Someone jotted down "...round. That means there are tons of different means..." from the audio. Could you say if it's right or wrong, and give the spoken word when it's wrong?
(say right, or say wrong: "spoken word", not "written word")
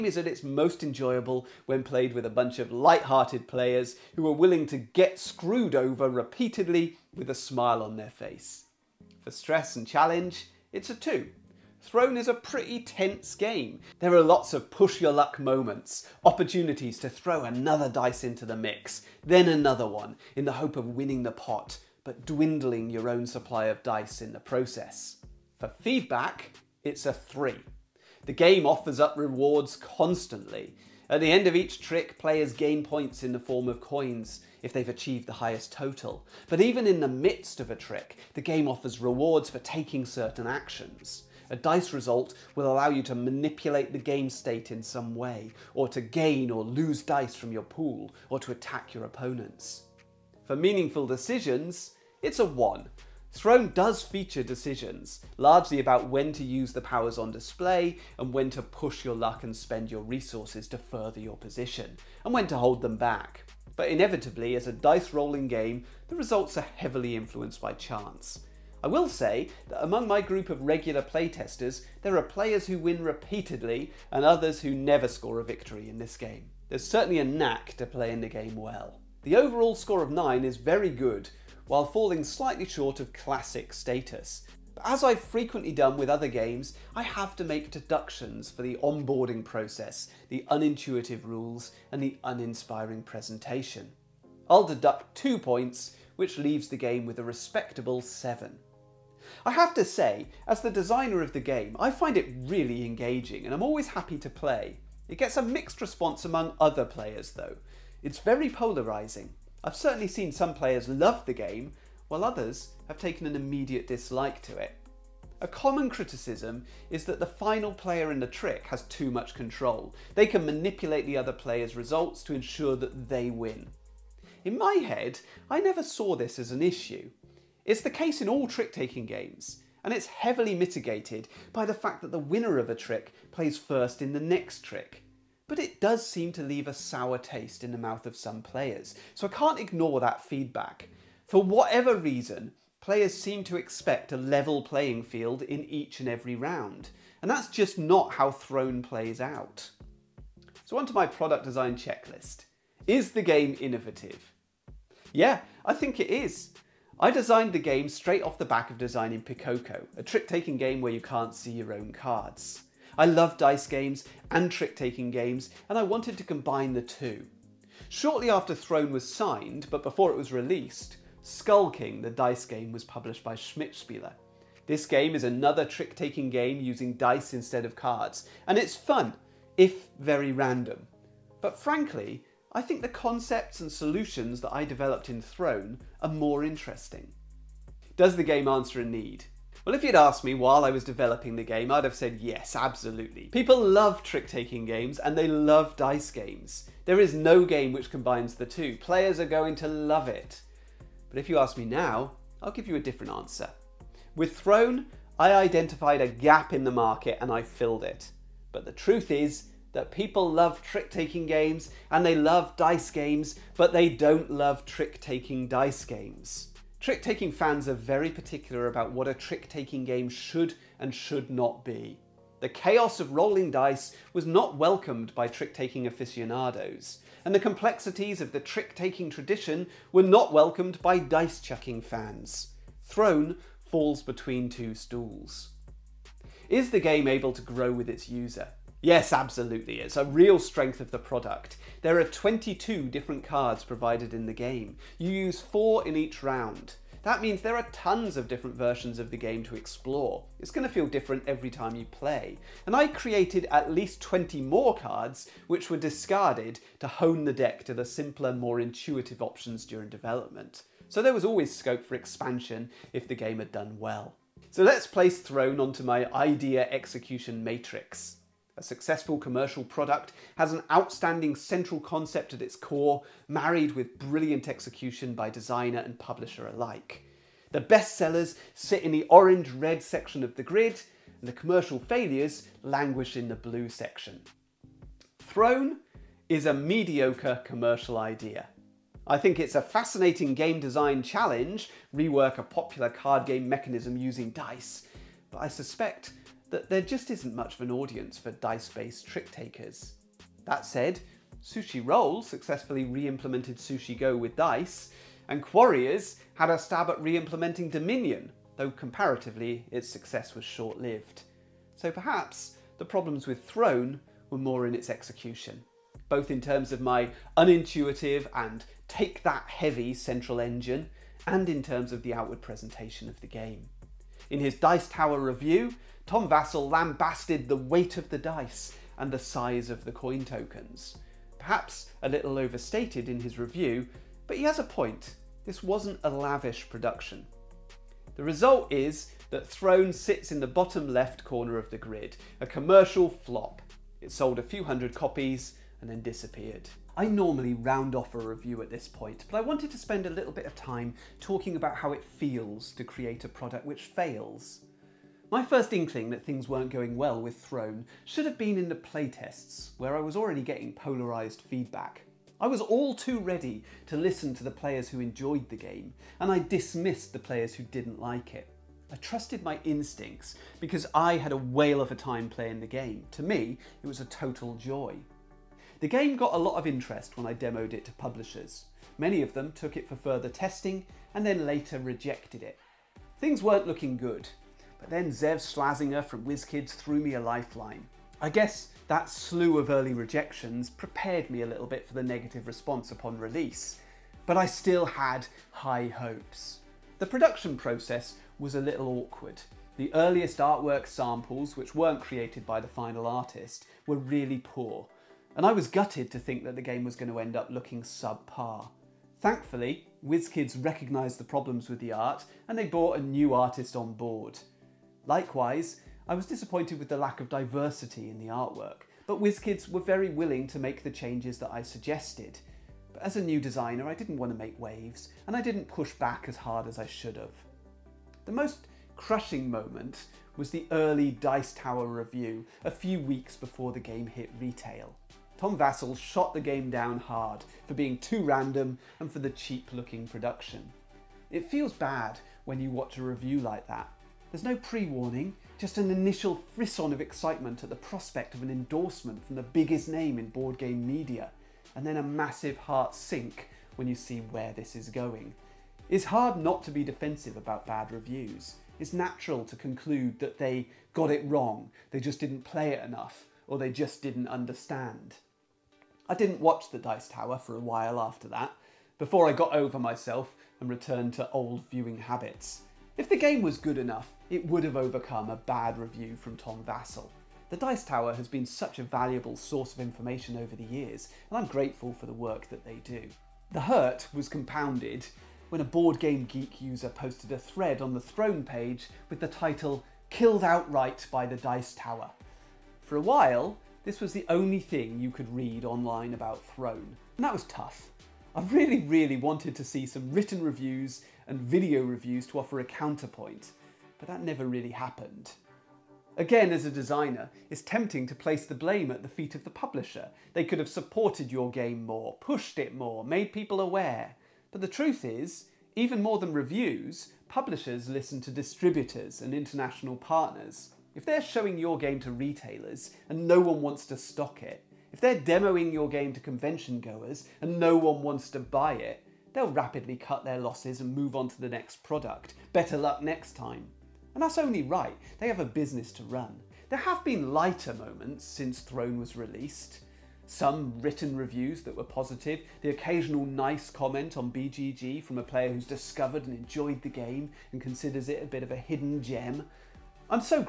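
wrong: "versions", not "means".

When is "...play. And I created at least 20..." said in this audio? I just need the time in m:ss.
4:11.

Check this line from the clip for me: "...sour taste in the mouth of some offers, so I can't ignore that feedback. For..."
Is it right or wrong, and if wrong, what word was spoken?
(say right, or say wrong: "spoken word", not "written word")
wrong: "players", not "offers".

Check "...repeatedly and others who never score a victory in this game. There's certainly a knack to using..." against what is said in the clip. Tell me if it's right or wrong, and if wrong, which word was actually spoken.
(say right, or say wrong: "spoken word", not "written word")
wrong: "playing", not "using".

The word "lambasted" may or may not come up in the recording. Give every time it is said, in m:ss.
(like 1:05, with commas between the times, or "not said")
5:26.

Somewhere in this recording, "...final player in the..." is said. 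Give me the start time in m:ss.
1:57.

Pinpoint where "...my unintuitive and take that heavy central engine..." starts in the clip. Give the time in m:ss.
5:16.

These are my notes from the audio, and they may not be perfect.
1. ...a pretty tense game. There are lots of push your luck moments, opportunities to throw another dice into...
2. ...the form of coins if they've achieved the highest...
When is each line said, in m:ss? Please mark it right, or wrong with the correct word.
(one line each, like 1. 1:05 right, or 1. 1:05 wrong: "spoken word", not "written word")
1. 0:12 right
2. 0:33 right.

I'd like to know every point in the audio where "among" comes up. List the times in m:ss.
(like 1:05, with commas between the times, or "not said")
1:09, 1:46.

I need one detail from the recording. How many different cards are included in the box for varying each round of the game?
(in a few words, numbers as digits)
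22.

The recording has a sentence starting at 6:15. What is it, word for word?
The game got a lot of interest when I demoed it to publishers.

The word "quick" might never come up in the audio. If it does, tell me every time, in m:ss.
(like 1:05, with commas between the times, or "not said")
not said.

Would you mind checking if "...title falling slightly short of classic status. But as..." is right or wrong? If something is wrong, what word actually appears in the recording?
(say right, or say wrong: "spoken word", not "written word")
wrong: "while", not "title".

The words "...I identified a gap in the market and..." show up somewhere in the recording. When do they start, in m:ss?
3:25.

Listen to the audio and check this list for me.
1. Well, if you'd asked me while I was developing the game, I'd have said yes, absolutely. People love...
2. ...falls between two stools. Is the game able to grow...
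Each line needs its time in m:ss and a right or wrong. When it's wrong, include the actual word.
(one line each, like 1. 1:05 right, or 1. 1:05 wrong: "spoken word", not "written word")
1. 3:09 right
2. 3:53 right.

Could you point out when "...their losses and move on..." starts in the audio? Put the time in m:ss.
8:50.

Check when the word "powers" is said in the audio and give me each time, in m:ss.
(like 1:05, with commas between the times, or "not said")
0:56.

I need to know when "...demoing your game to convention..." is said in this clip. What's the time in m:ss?
8:45.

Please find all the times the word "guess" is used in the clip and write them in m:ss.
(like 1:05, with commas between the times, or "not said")
6:28.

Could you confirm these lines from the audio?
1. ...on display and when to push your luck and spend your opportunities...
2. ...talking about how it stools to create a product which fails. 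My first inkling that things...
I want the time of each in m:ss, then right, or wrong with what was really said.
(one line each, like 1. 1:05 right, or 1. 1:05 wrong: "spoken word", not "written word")
1. 0:57 wrong: "resources", not "opportunities"
2. 5:51 wrong: "feels", not "stools".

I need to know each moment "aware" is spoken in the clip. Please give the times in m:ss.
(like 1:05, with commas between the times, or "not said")
8:33.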